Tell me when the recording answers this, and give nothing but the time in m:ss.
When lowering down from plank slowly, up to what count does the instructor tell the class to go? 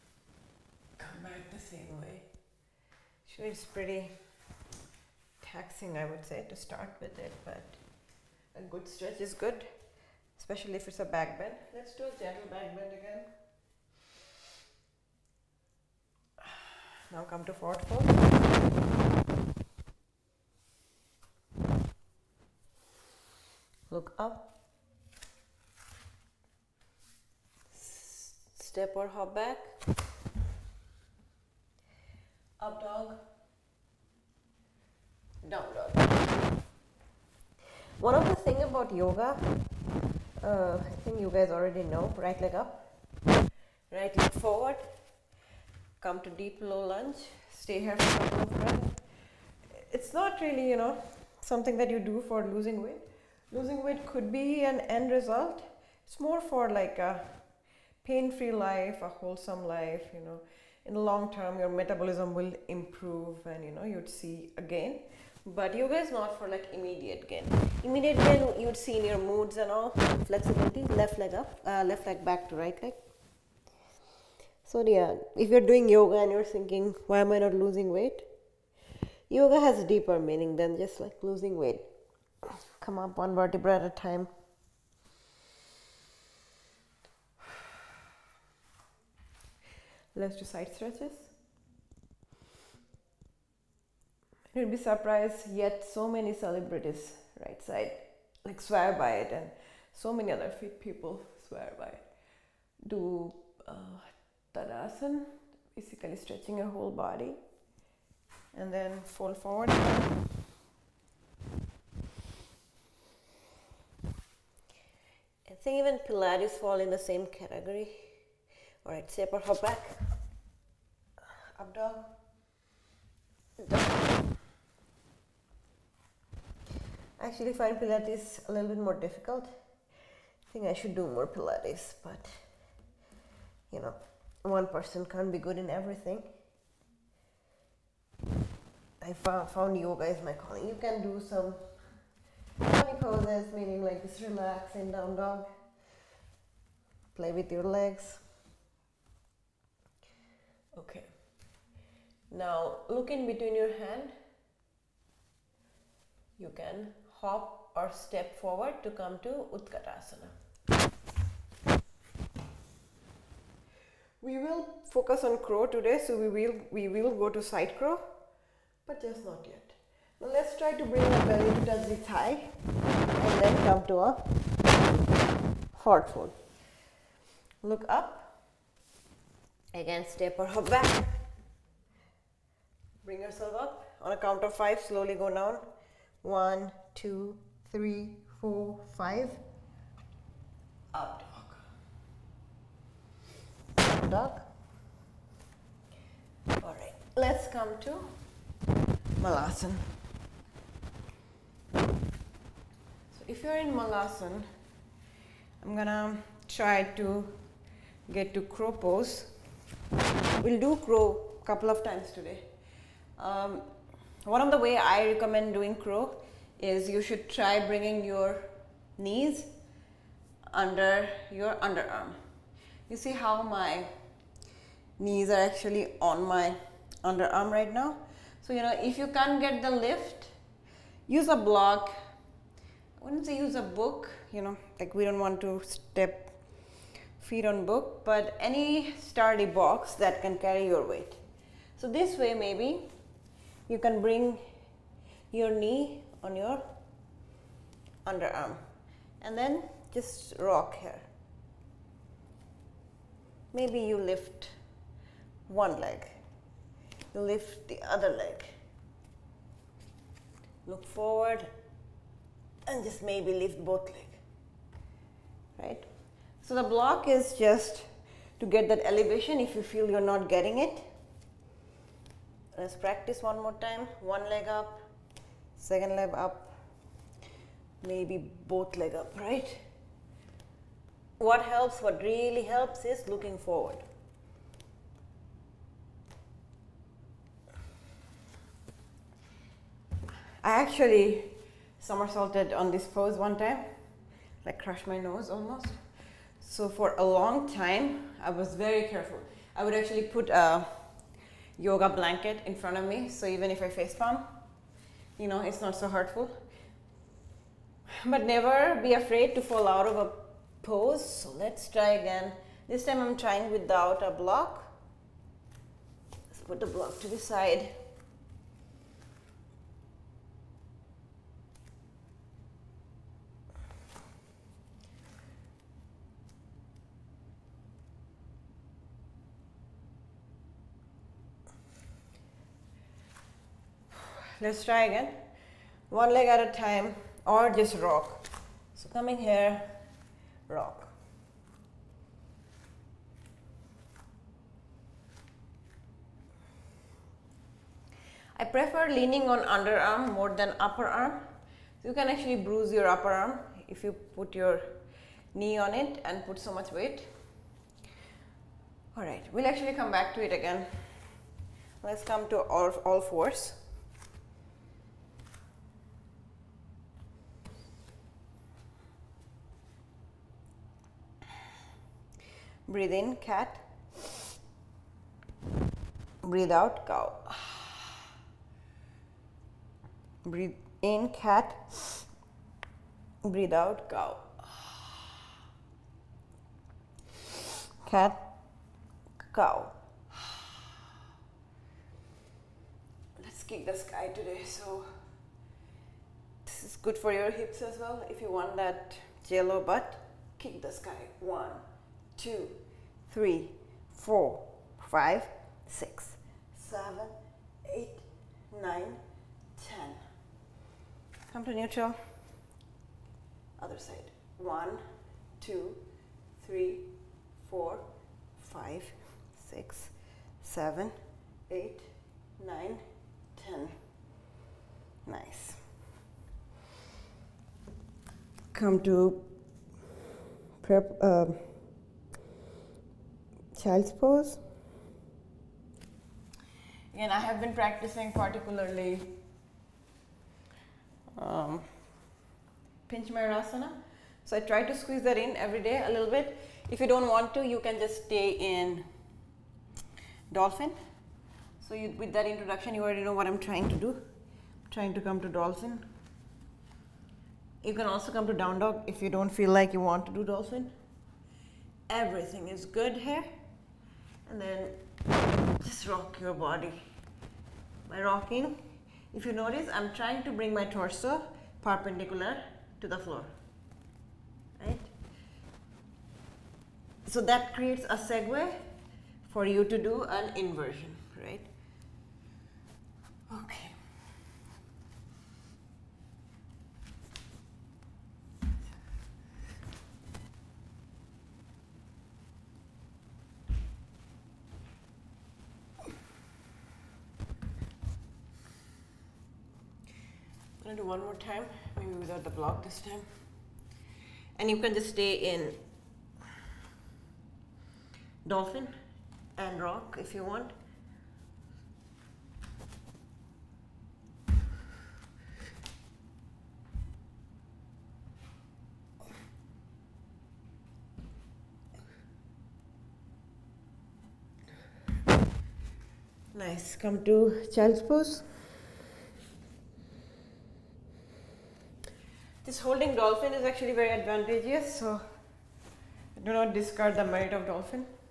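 3:03.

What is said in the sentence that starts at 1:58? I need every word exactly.
All right, step or hop back, up dog.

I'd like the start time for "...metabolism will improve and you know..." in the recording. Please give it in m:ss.
1:01.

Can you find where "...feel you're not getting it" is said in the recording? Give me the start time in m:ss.
4:29.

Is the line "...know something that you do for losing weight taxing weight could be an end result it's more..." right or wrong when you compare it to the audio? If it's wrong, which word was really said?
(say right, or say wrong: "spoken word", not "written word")
wrong: "losing", not "taxing".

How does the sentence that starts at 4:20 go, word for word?
Look forward and just maybe lift both legs.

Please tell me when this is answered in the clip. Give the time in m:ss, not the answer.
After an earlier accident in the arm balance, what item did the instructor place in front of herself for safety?
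5:01.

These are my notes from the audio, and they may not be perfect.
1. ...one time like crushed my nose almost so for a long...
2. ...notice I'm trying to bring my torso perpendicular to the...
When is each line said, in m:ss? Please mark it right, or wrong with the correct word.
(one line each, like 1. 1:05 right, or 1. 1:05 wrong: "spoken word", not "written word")
1. 4:53 right
2. 7:49 right.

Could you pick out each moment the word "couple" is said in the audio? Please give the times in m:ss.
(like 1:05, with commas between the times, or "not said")
0:48, 3:31.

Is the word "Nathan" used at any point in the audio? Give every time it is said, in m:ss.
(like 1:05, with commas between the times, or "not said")
not said.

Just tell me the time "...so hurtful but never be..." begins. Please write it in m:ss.
5:05.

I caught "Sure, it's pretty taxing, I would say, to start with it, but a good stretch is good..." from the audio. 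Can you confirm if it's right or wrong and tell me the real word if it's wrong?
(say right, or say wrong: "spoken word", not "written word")
right.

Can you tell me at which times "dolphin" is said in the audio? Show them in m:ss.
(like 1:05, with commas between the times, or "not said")
7:30, 7:35, 7:40, 8:28, 8:52, 8:57.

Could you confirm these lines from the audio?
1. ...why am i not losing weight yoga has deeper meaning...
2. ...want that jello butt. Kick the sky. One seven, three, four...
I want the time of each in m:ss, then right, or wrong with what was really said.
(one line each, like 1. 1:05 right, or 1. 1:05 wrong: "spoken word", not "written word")
1. 1:17 right
2. 6:38 wrong: "two", not "seven".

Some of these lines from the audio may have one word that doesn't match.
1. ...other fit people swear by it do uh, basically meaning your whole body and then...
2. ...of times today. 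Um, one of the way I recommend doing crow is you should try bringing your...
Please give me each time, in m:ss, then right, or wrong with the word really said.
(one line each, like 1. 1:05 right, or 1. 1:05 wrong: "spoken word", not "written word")
1. 1:40 wrong: "stretching", not "meaning"
2. 3:31 right.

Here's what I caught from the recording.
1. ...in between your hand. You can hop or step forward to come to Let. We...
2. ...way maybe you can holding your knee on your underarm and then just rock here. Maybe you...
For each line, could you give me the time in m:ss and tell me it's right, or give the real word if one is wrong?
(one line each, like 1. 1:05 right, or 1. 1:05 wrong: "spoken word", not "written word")
1. 2:33 wrong: "Utkatasana", not "Let"
2. 4:02 wrong: "bring", not "holding".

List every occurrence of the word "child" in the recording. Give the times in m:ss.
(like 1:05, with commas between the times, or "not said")
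7:13, 8:47.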